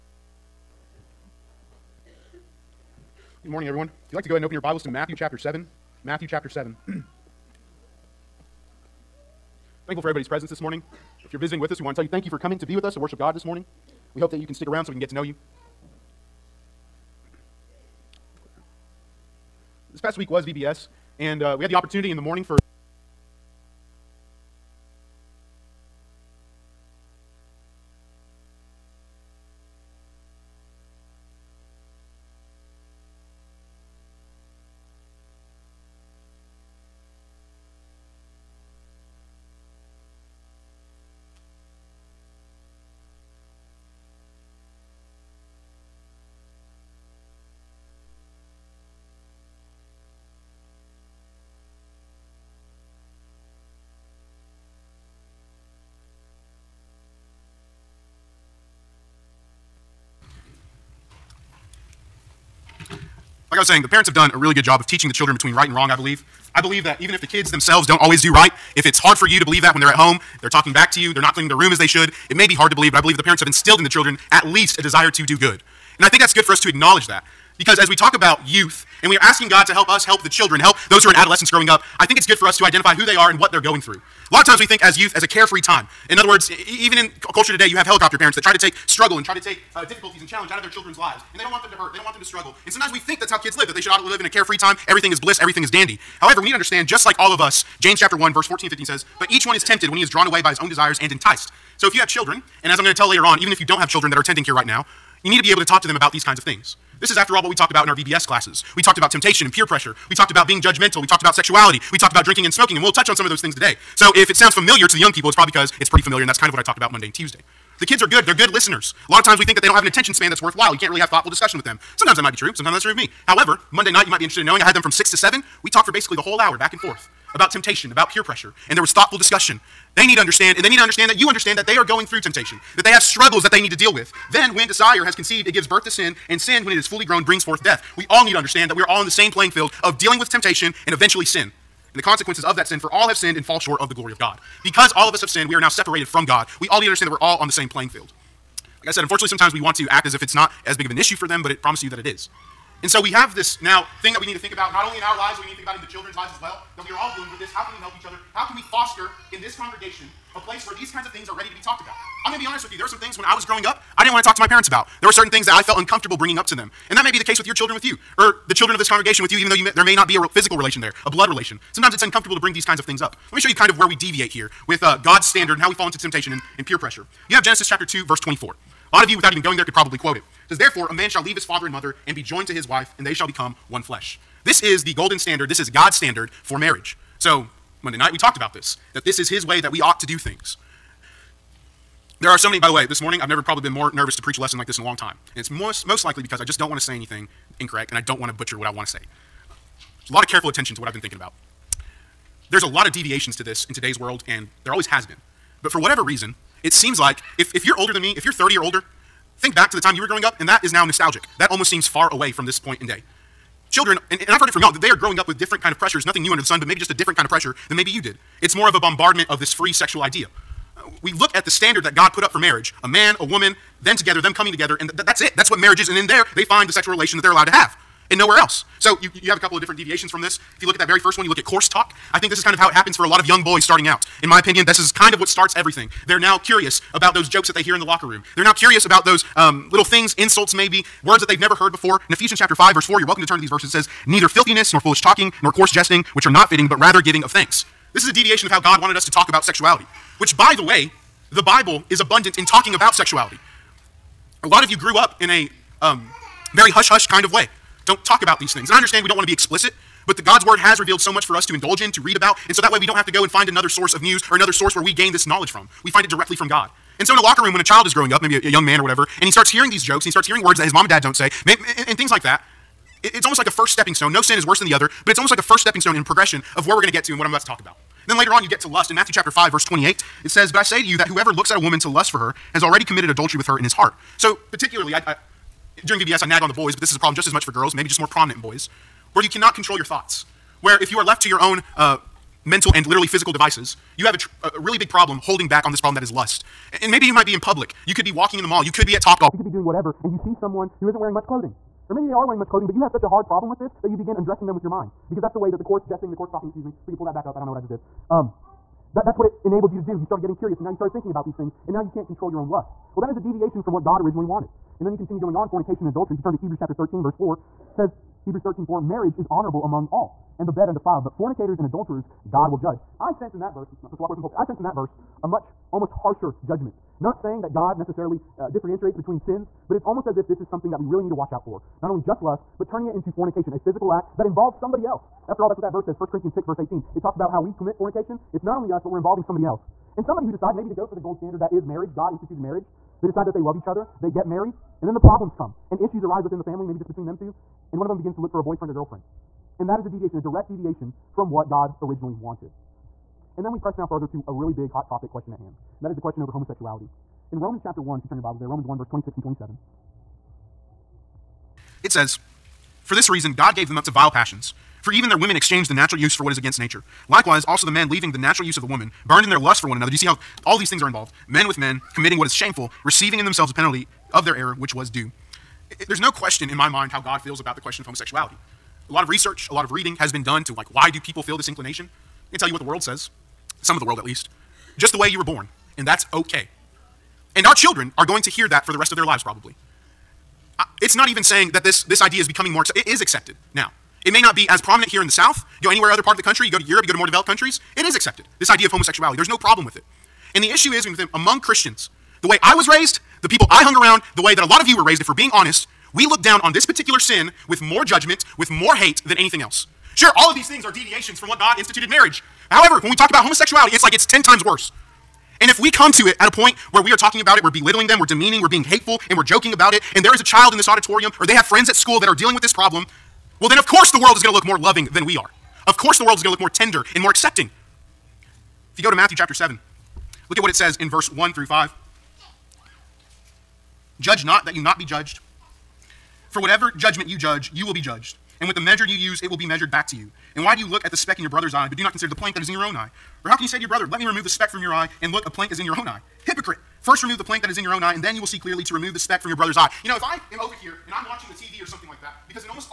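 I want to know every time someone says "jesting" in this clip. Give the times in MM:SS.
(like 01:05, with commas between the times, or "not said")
04:05, 05:05.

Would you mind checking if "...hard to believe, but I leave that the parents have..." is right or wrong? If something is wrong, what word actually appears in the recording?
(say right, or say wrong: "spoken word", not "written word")
wrong: "believe", not "leave".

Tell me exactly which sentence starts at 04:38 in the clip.
And then later on, you get to lust.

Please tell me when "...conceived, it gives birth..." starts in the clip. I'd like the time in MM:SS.
02:15.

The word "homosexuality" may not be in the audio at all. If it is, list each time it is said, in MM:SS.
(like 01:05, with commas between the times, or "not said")
05:56, 06:17, 06:38, 06:53.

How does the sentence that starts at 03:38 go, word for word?
It's more of a bombardment of this free sexual idea.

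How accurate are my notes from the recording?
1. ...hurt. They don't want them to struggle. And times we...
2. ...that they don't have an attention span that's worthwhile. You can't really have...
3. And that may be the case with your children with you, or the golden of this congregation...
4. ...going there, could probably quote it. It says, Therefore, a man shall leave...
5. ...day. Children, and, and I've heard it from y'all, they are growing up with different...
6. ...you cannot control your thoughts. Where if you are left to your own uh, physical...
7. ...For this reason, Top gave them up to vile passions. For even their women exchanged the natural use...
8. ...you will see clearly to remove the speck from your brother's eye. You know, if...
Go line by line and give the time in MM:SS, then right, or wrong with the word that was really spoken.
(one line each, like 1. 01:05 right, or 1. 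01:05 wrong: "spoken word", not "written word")
1. 01:31 wrong: "sometimes", not "times"
2. 01:59 right
3. 02:46 wrong: "children", not "golden"
4. 02:59 right
5. 03:32 right
6. 04:49 wrong: "mental", not "physical"
7. 06:02 wrong: "God", not "Top"
8. 07:28 right.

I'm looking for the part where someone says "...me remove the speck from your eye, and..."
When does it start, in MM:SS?
07:23.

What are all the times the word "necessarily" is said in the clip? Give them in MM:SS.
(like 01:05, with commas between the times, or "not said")
05:27.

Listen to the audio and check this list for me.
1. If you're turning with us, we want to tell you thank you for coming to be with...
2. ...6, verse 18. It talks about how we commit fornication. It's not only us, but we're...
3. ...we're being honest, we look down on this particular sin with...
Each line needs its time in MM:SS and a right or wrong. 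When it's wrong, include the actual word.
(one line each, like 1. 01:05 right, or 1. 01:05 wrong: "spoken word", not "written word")
1. 00:11 wrong: "visiting", not "turning"
2. 05:36 right
3. 06:45 right.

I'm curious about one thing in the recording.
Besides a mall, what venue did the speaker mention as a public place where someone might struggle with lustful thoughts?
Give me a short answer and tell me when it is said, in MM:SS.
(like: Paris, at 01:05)
Top Golf, at 04:59.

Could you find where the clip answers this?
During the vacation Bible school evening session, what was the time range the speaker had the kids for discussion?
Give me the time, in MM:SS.
02:04.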